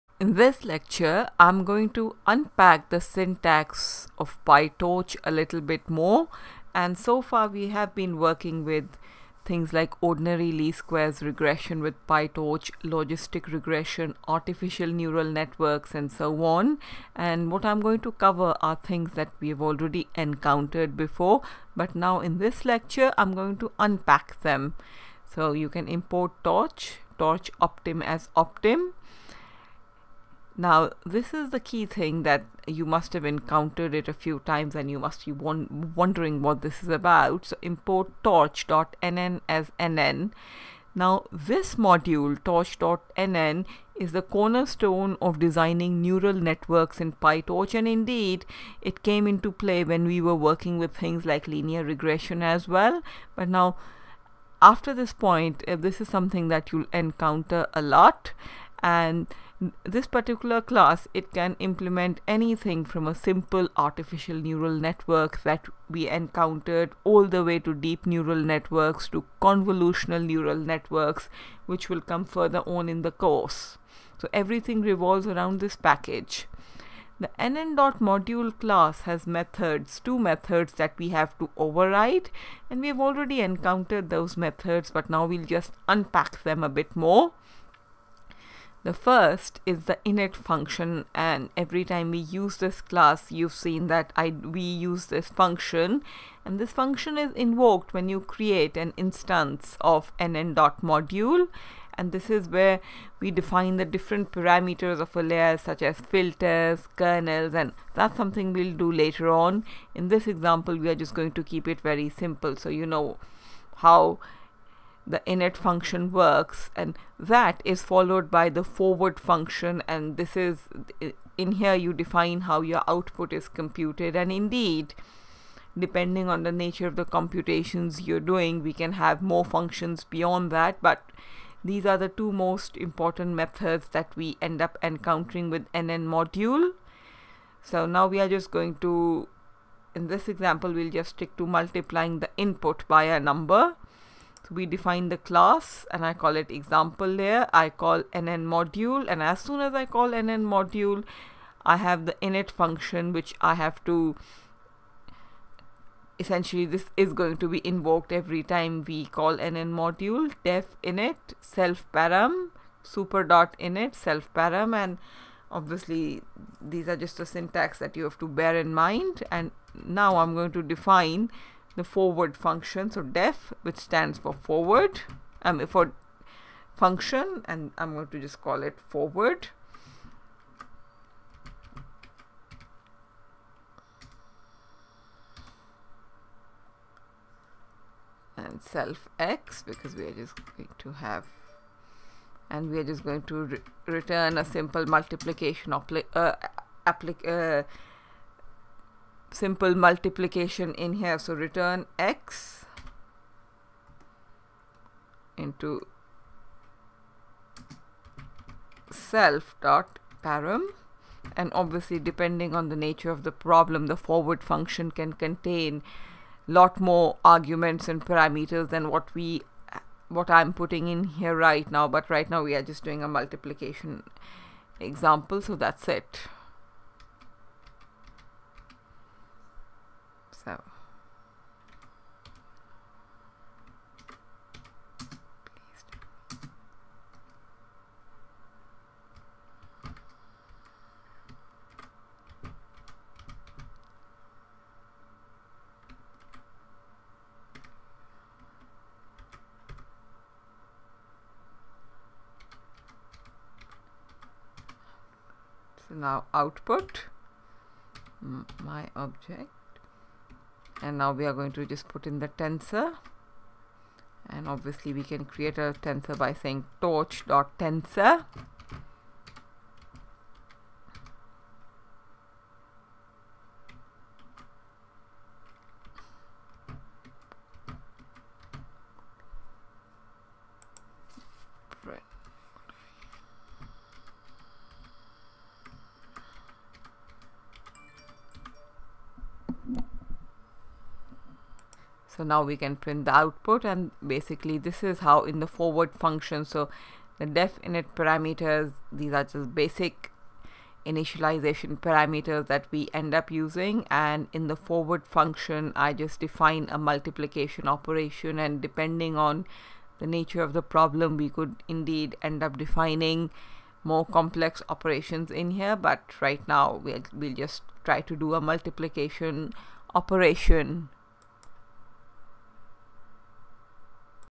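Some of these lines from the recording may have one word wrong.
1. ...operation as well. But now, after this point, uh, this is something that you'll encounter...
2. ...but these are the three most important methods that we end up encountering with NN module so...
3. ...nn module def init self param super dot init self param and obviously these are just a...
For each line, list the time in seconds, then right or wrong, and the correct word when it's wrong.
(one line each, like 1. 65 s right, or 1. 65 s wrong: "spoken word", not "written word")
1. 51 s wrong: "regression", not "operation"
2. 130 s wrong: "two", not "three"
3. 159 s right.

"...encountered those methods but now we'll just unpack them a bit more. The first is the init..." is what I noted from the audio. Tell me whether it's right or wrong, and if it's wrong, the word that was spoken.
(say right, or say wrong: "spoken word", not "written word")
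right.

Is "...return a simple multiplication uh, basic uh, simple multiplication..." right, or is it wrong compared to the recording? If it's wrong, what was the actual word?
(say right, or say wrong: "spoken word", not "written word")
wrong: "applic", not "basic".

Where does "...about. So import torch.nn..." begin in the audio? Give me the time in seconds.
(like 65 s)
36 s.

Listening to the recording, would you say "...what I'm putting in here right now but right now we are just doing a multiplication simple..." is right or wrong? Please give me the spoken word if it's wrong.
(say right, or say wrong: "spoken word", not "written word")
wrong: "example", not "simple".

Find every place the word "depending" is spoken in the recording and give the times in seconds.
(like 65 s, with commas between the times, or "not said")
125 s, 211 s, 308 s.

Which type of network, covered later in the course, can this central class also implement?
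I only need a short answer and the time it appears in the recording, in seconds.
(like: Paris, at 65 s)
convolutional neural networks, at 69 s.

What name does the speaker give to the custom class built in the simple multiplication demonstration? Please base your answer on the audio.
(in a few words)
example layer.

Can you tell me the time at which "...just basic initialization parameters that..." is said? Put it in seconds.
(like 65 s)
299 s.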